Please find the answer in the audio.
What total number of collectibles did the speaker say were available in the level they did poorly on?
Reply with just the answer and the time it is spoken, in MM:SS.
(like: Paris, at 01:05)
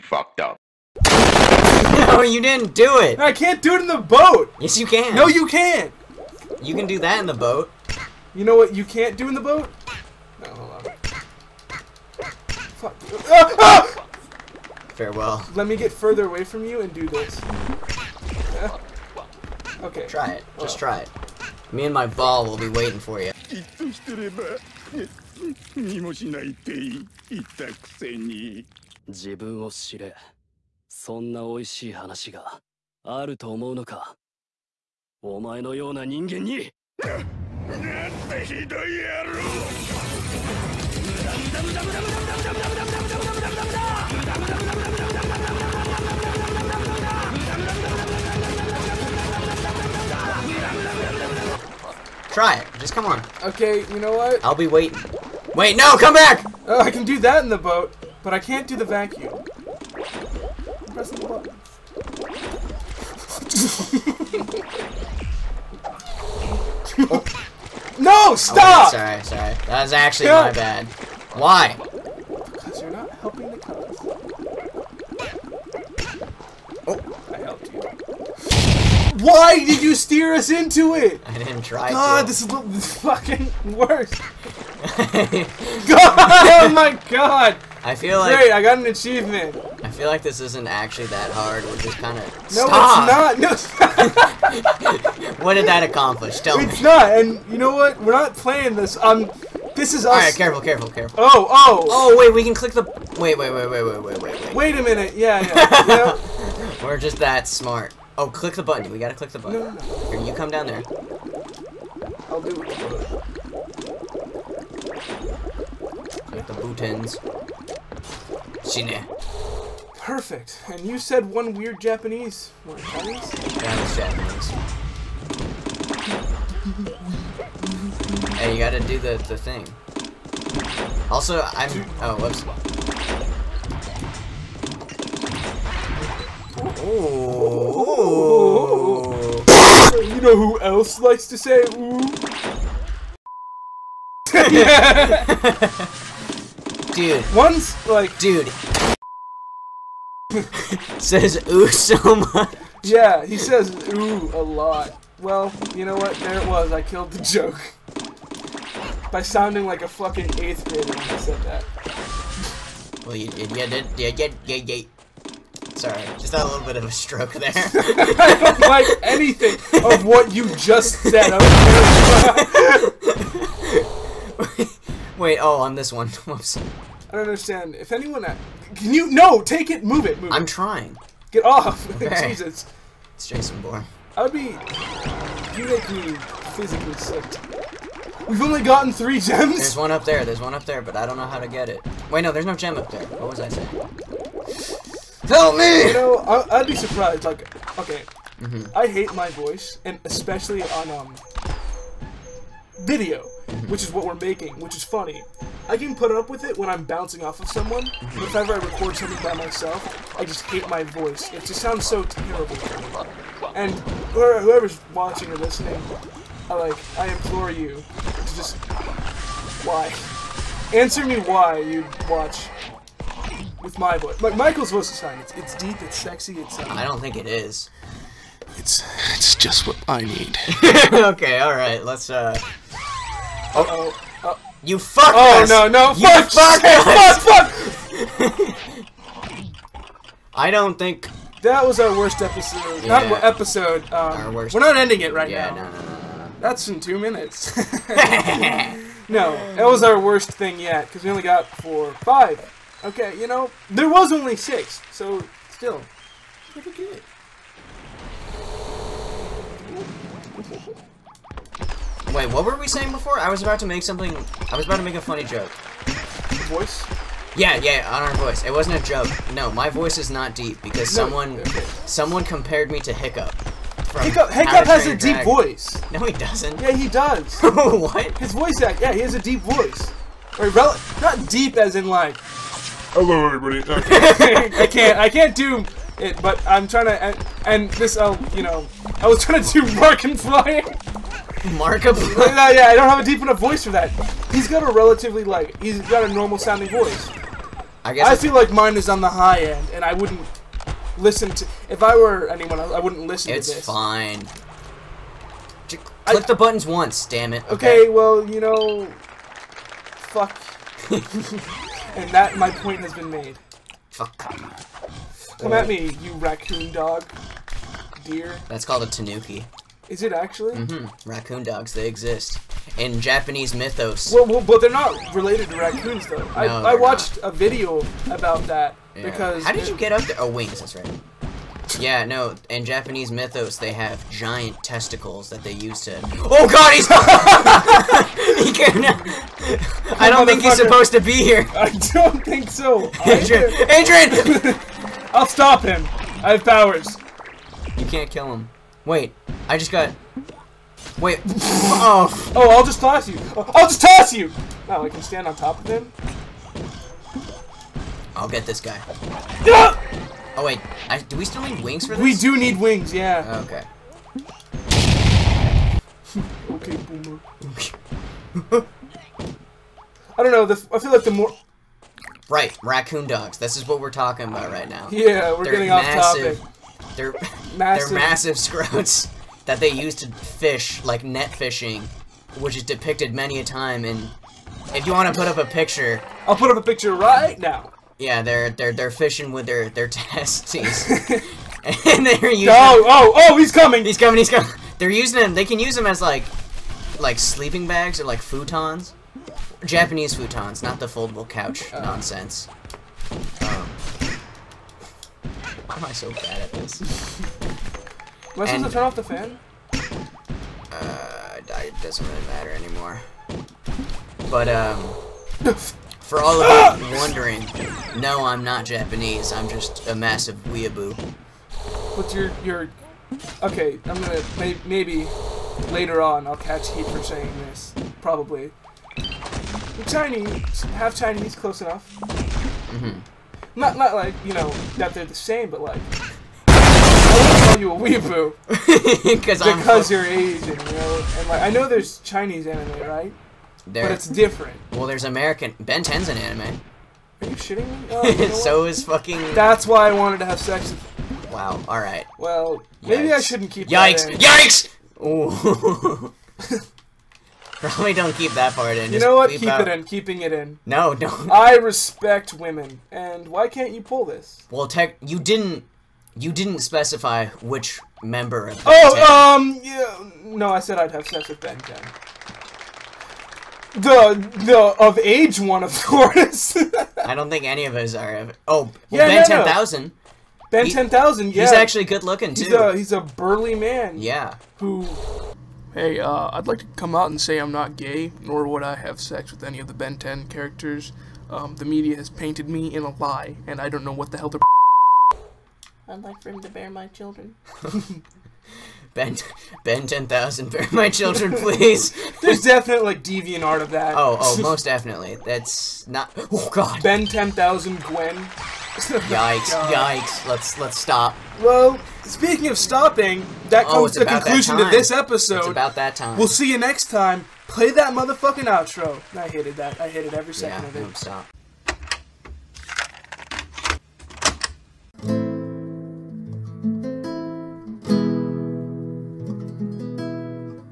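6, at 04:14.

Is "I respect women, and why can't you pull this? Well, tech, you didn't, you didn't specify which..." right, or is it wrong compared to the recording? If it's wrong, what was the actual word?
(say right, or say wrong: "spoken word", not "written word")
right.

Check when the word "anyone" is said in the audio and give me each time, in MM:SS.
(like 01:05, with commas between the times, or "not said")
02:57, 05:02.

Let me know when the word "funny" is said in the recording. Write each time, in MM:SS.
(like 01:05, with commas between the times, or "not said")
03:24, 04:25.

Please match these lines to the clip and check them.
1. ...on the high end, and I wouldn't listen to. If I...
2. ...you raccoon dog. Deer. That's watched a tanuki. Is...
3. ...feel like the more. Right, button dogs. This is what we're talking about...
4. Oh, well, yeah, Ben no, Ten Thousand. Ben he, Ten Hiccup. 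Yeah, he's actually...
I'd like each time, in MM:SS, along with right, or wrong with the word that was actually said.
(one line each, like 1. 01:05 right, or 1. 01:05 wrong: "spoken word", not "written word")
1. 04:58 right
2. 05:15 wrong: "called", not "watched"
3. 06:10 wrong: "raccoon", not "button"
4. 07:58 wrong: "Thousand", not "Hiccup".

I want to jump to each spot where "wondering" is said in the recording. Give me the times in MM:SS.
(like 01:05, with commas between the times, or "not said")
06:56.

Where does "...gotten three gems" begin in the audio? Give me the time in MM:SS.
03:08.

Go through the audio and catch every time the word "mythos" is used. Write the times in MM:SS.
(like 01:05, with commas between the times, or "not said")
05:23, 05:33.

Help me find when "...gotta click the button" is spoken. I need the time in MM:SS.
01:48.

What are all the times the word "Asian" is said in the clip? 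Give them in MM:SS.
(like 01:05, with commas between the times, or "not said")
07:20.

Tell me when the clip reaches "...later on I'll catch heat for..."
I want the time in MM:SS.
07:05.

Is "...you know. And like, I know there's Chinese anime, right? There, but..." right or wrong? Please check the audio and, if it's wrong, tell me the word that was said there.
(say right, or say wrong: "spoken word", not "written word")
right.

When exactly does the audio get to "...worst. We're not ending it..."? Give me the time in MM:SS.
04:04.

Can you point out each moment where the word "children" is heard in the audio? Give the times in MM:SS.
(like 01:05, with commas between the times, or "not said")
08:16, 08:20.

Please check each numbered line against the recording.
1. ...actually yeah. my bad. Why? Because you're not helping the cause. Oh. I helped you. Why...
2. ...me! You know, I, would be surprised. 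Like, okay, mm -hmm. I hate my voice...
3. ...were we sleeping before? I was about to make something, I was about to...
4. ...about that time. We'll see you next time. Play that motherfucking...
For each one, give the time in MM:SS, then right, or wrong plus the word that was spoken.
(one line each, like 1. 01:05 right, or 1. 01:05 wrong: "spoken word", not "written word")
1. 01:09 right
2. 03:15 right
3. 04:22 wrong: "saying", not "sleeping"
4. 08:35 right.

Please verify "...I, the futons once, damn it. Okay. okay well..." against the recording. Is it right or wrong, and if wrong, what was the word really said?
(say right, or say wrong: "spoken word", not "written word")
wrong: "buttons", not "futons".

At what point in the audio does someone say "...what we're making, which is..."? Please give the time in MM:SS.
03:23.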